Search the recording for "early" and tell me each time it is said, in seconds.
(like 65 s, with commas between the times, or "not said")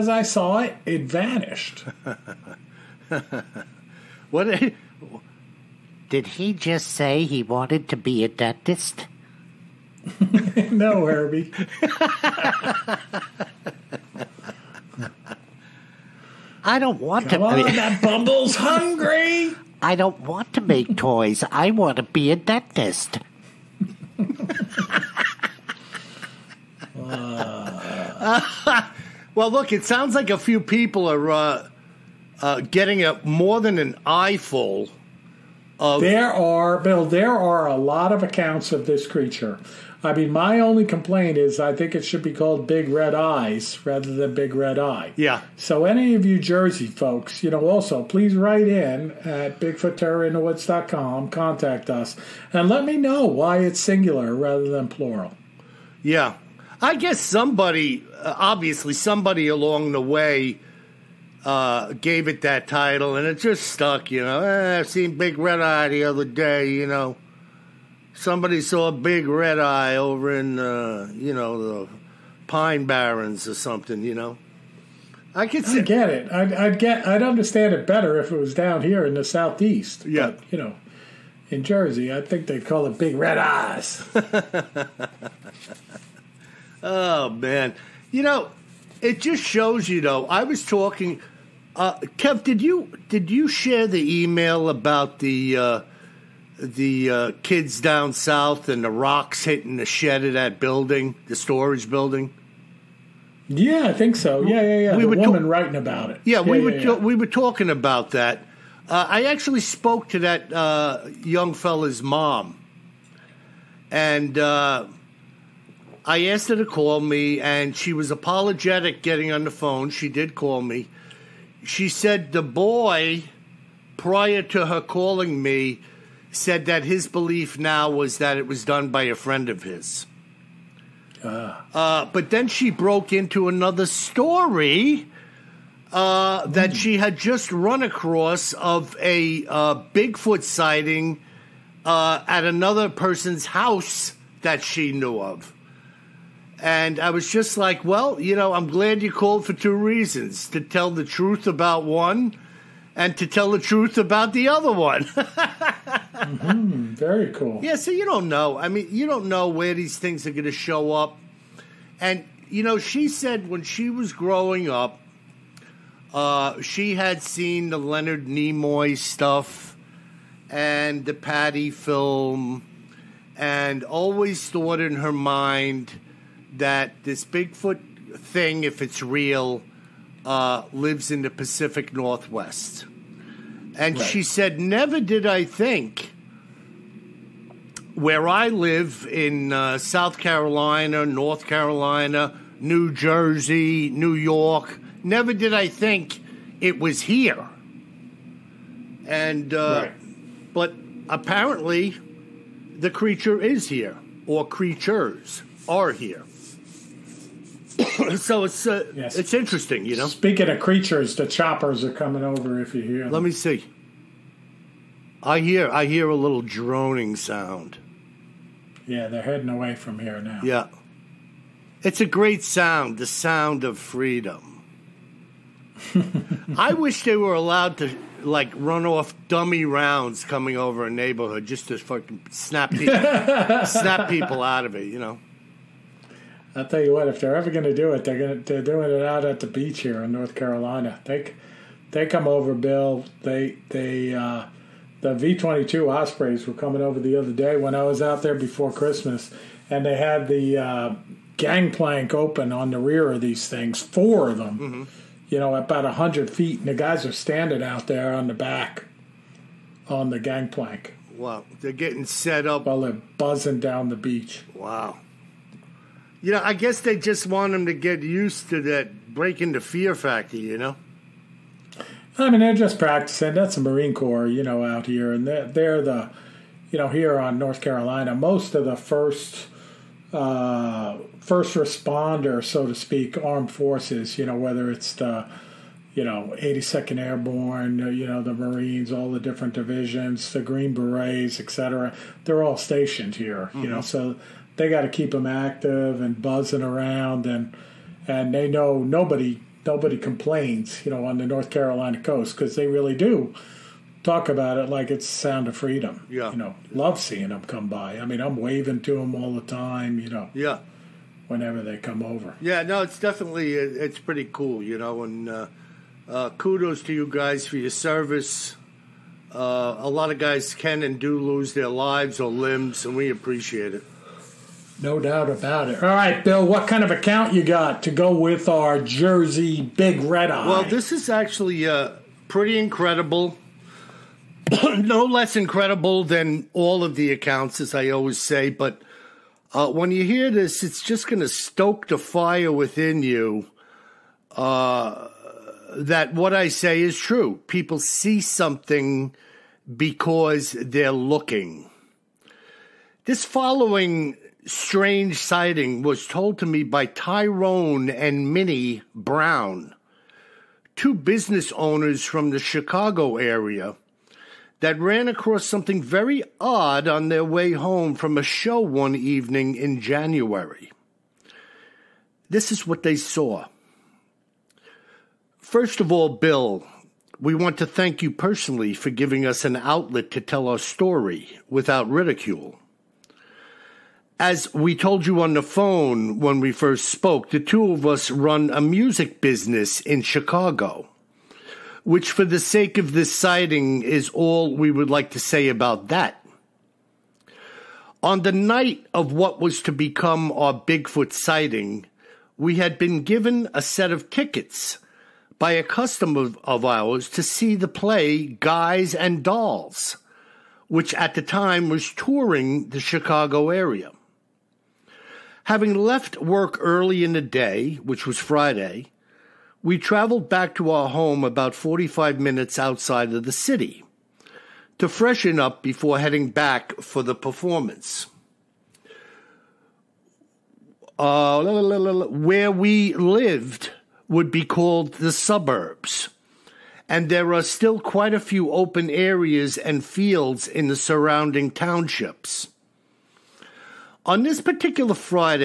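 416 s.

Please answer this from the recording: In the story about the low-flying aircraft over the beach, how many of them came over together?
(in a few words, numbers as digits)
4.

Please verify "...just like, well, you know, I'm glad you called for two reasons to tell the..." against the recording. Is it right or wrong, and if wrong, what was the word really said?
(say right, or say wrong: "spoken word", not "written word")
right.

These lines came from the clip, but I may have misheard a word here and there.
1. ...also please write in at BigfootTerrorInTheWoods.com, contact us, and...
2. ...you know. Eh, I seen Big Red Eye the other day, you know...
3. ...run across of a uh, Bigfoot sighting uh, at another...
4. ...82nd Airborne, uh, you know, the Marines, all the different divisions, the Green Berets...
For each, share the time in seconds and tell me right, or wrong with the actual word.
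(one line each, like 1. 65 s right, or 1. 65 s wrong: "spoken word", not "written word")
1. 47 s right
2. 64 s right
3. 137 s right
4. 286 s right.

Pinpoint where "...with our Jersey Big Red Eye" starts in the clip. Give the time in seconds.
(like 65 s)
328 s.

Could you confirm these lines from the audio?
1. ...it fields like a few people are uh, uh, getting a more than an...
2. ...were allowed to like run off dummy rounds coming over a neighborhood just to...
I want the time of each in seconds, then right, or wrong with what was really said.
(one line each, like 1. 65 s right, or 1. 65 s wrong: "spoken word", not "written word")
1. 29 s wrong: "sounds", not "fields"
2. 227 s right.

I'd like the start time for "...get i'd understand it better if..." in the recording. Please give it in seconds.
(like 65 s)
76 s.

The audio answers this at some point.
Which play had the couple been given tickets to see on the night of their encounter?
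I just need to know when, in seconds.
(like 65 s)
408 s.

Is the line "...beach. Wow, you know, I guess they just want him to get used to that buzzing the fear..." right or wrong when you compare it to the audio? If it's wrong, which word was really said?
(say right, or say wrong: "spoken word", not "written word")
wrong: "breaking", not "buzzing".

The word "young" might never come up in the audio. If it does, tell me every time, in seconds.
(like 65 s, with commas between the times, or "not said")
111 s.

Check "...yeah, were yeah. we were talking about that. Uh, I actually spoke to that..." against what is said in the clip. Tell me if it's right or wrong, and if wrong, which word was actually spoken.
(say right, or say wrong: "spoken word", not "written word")
right.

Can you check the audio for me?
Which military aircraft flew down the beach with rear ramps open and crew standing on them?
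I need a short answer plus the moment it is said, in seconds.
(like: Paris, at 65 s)
V-22 Ospreys, at 245 s.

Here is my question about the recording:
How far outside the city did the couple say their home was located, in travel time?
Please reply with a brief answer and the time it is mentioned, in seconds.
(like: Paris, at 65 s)
45 minutes, at 421 s.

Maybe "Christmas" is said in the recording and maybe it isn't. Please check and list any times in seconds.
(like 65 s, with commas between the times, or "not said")
248 s.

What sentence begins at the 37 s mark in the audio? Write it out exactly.
There are a lot of accounts of this creature.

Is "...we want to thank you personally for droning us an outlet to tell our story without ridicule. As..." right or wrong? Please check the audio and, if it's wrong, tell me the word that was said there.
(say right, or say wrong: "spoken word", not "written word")
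wrong: "giving", not "droning".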